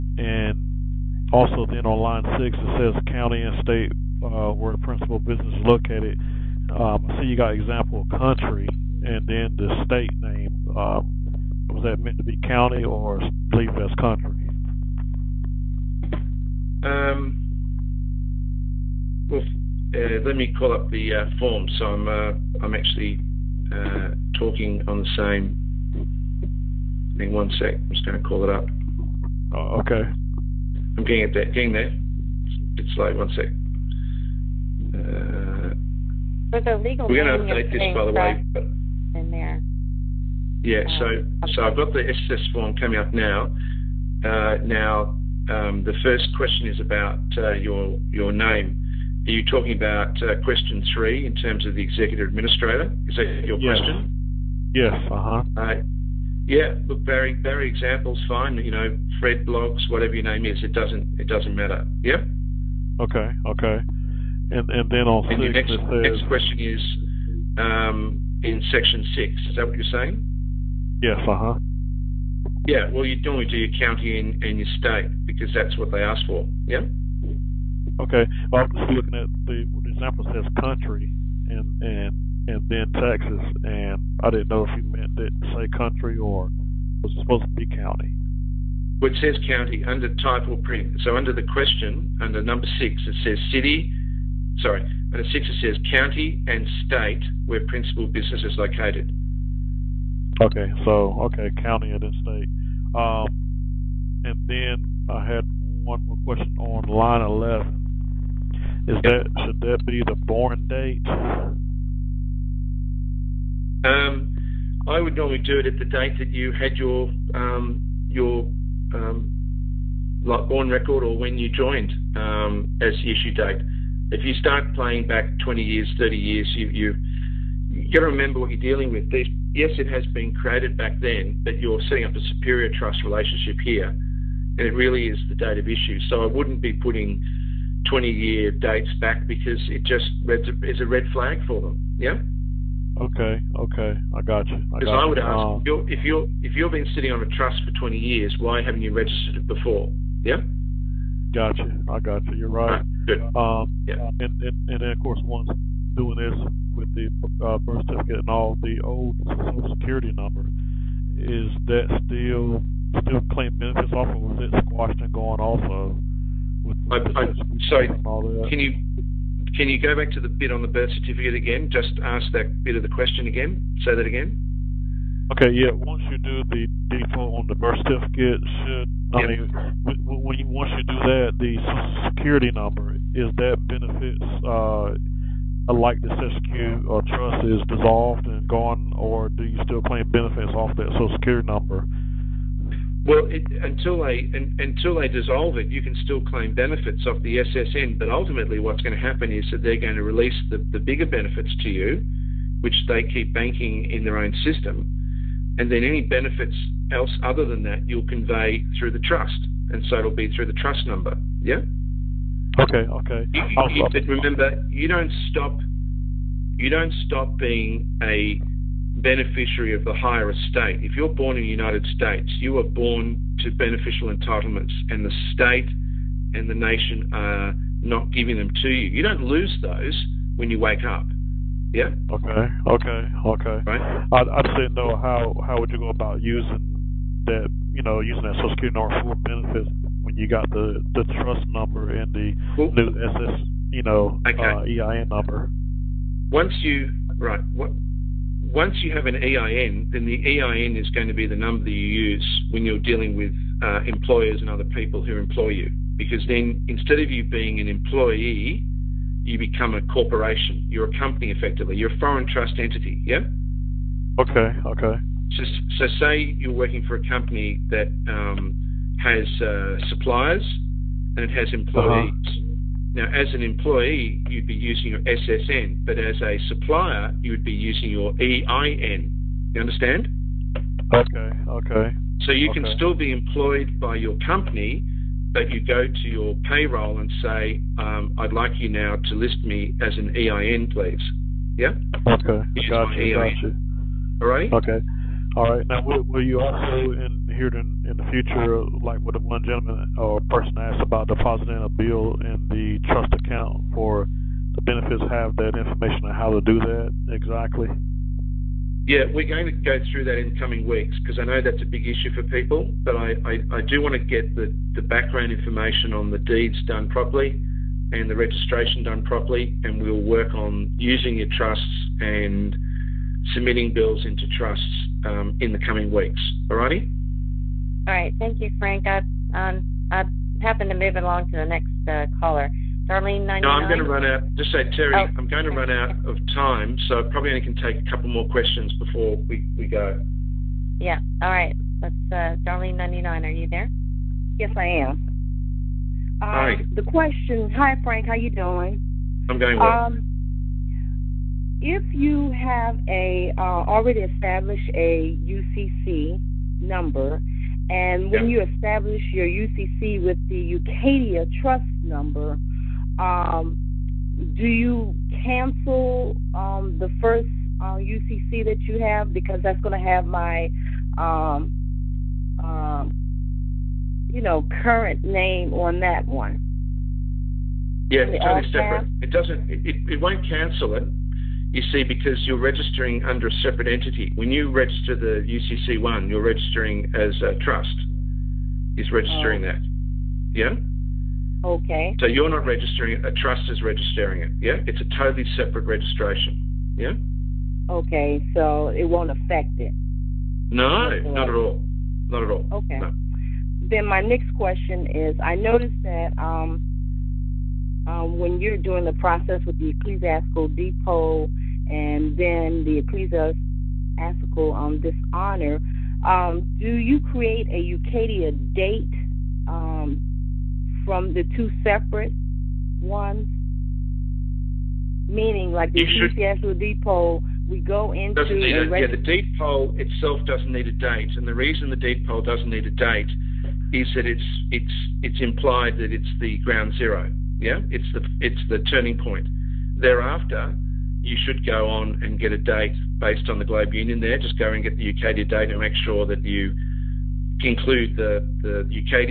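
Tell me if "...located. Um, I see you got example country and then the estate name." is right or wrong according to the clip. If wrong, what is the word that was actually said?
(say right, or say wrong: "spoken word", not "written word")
wrong: "state", not "estate".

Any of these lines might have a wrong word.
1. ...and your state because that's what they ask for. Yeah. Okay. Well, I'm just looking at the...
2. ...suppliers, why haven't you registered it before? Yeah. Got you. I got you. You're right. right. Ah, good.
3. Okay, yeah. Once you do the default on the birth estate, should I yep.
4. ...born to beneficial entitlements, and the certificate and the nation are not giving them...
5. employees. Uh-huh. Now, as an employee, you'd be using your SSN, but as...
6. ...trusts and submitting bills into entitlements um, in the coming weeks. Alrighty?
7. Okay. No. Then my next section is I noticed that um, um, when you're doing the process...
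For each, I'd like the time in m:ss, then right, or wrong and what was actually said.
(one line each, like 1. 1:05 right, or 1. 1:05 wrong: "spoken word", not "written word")
1. 1:14 right
2. 2:27 wrong: "years", not "suppliers"
3. 2:55 wrong: "certificate", not "estate"
4. 3:42 wrong: "state", not "certificate"
5. 4:31 right
6. 5:21 wrong: "trusts", not "entitlements"
7. 6:42 wrong: "question", not "section".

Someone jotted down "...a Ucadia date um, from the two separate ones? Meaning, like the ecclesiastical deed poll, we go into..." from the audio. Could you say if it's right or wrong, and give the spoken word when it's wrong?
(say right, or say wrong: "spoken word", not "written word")
right.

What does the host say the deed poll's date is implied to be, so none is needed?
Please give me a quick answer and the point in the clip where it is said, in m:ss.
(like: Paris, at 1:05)
ground zero, at 7:16.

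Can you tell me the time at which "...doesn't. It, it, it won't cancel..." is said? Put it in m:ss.
6:19.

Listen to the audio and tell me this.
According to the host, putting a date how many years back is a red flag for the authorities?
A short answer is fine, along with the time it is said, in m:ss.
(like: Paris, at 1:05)
20 years, at 2:17.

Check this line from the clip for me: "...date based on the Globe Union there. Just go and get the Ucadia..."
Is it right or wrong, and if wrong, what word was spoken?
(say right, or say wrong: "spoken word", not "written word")
right.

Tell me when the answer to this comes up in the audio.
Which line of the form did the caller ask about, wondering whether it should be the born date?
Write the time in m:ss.
1:46.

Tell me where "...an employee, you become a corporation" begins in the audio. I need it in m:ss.
4:17.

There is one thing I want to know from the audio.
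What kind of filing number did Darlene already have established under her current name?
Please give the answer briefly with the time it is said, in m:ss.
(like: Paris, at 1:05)
UCC number, at 5:55.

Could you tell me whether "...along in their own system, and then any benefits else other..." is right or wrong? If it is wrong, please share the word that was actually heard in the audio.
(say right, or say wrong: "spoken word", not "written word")
wrong: "banking", not "along".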